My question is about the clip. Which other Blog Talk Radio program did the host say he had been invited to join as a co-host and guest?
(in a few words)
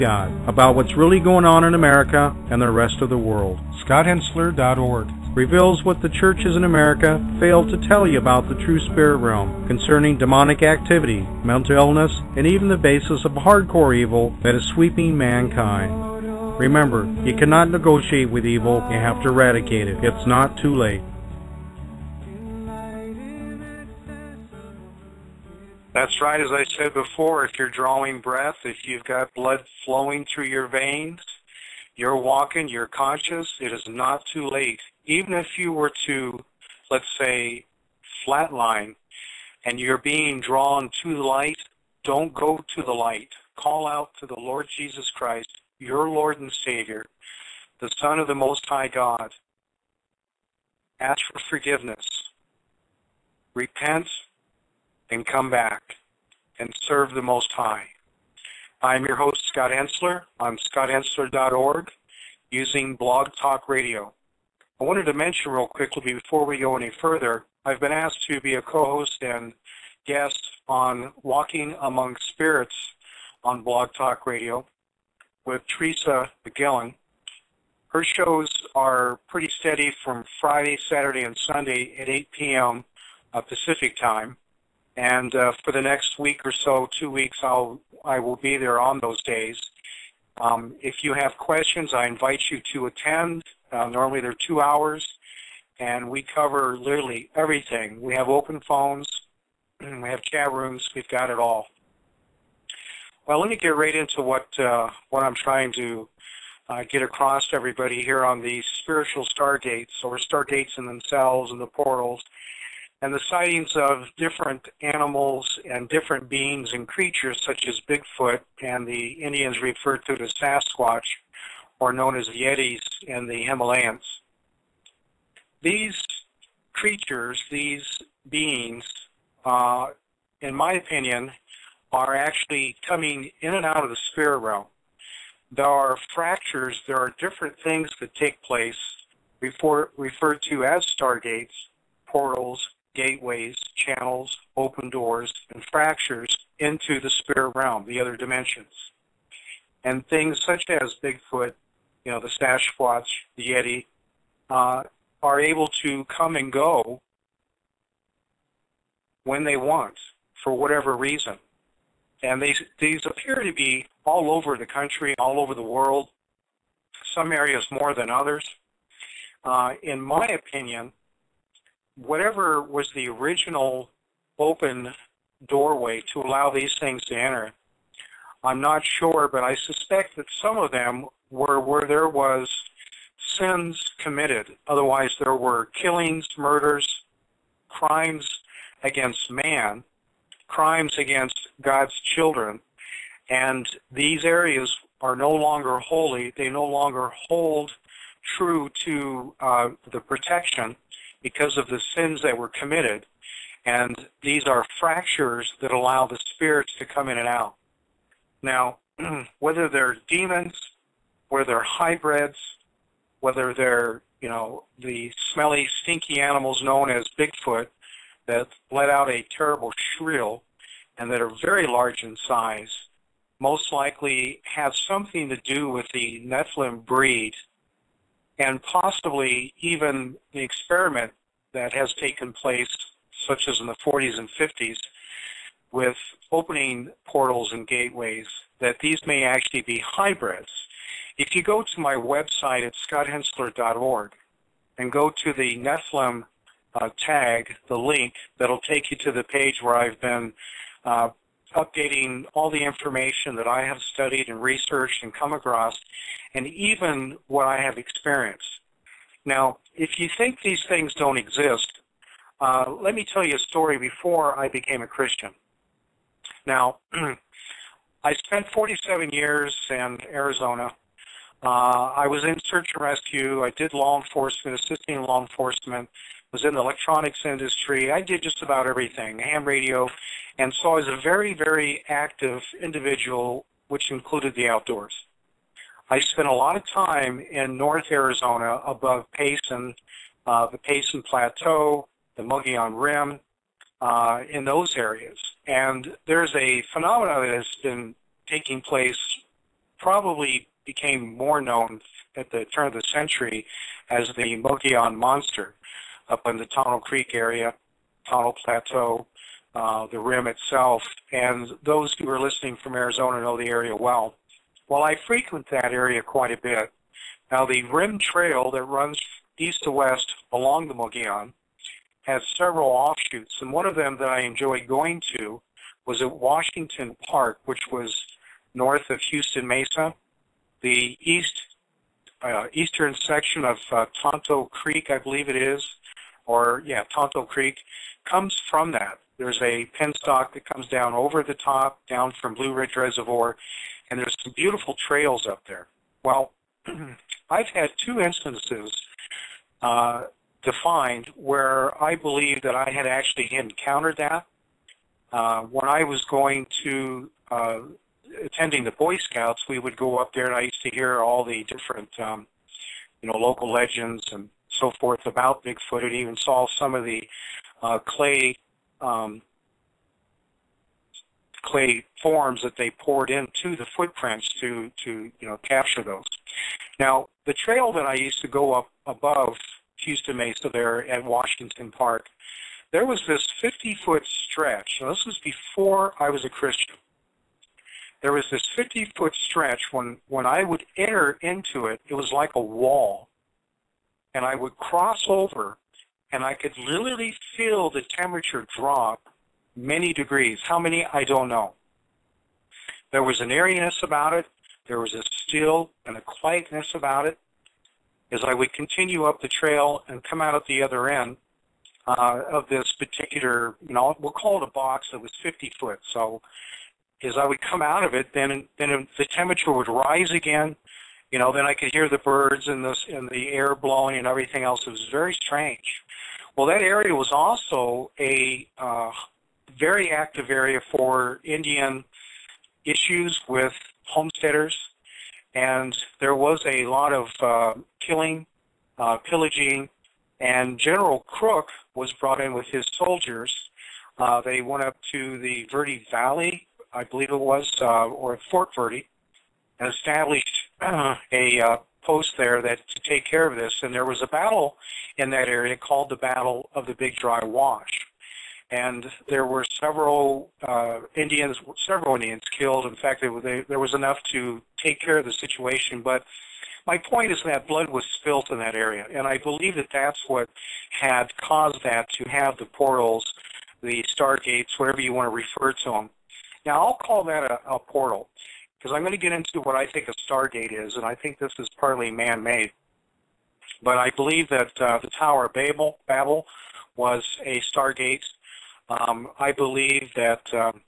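Walking Among Spirits.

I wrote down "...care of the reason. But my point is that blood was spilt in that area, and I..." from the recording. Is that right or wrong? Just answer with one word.
wrong.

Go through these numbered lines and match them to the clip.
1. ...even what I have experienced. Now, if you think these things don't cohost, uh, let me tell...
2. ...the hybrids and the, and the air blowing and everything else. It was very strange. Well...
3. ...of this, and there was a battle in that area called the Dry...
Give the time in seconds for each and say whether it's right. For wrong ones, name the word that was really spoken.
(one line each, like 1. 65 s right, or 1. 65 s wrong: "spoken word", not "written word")
1. 256 s wrong: "exist", not "cohost"
2. 421 s wrong: "birds", not "hybrids"
3. 453 s wrong: "Battle", not "Dry".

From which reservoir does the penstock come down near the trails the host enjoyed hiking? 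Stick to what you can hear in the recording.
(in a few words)
Blue Ridge Reservoir.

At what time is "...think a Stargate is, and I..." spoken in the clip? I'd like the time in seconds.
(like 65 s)
479 s.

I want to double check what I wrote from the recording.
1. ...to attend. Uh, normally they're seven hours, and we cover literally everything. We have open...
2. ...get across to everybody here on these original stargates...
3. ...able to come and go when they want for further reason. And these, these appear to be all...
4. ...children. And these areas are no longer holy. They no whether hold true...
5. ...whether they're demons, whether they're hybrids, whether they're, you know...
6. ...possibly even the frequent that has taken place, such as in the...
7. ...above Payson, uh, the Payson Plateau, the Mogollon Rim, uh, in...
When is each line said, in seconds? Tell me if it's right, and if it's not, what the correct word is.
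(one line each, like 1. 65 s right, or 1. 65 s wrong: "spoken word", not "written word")
1. 92 s wrong: "two", not "seven"
2. 106 s wrong: "spiritual", not "original"
3. 155 s wrong: "whatever", not "further"
4. 192 s wrong: "longer", not "whether"
5. 209 s right
6. 228 s wrong: "experiment", not "frequent"
7. 288 s right.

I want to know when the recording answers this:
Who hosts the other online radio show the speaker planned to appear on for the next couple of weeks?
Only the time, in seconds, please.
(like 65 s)
75 s.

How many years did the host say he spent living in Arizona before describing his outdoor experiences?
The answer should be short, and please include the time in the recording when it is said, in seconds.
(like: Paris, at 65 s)
47, at 268 s.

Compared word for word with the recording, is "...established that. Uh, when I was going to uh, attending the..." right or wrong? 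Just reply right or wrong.
wrong.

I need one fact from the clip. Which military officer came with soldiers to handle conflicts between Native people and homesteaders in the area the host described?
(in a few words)
General Crook.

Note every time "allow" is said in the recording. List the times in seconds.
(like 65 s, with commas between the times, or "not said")
176 s, 205 s.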